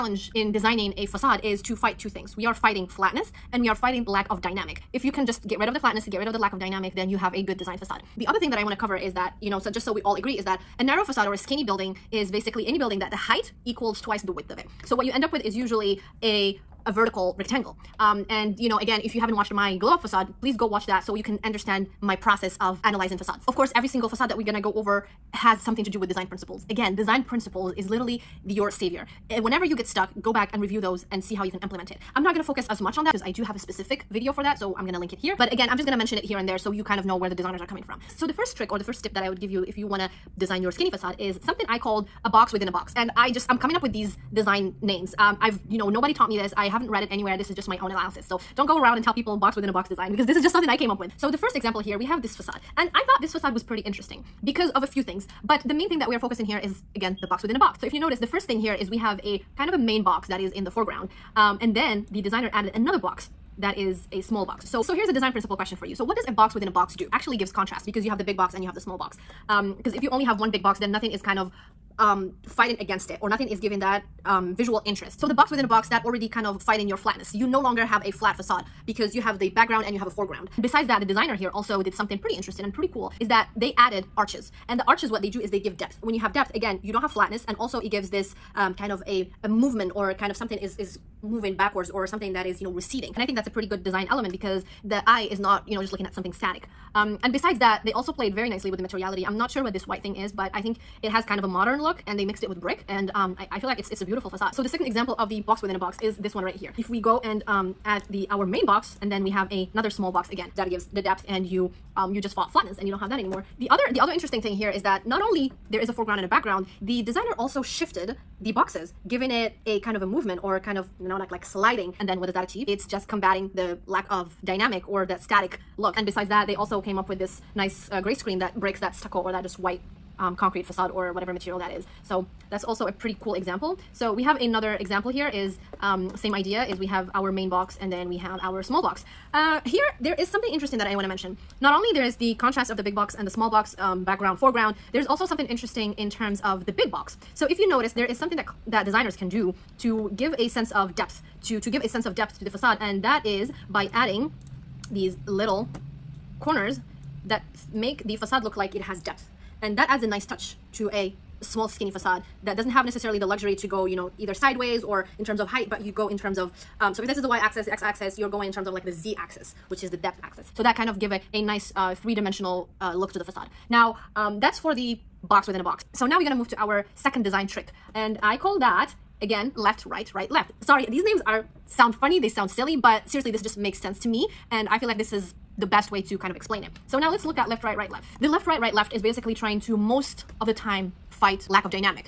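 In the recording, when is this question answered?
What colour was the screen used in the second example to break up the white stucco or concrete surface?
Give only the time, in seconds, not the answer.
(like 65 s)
127 s.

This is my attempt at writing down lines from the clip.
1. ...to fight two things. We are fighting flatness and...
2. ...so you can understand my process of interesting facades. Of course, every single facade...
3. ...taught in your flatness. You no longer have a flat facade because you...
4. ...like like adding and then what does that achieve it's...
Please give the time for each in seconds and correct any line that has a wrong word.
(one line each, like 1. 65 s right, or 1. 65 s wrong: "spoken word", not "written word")
1. 1 s right
2. 21 s wrong: "analyzing", not "interesting"
3. 76 s wrong: "fight", not "taught"
4. 121 s wrong: "sliding", not "adding".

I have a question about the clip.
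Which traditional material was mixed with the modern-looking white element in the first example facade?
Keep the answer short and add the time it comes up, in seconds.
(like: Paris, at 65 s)
Brick, at 102 s.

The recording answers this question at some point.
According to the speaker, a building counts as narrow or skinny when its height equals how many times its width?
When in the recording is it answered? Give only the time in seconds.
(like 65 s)
14 s.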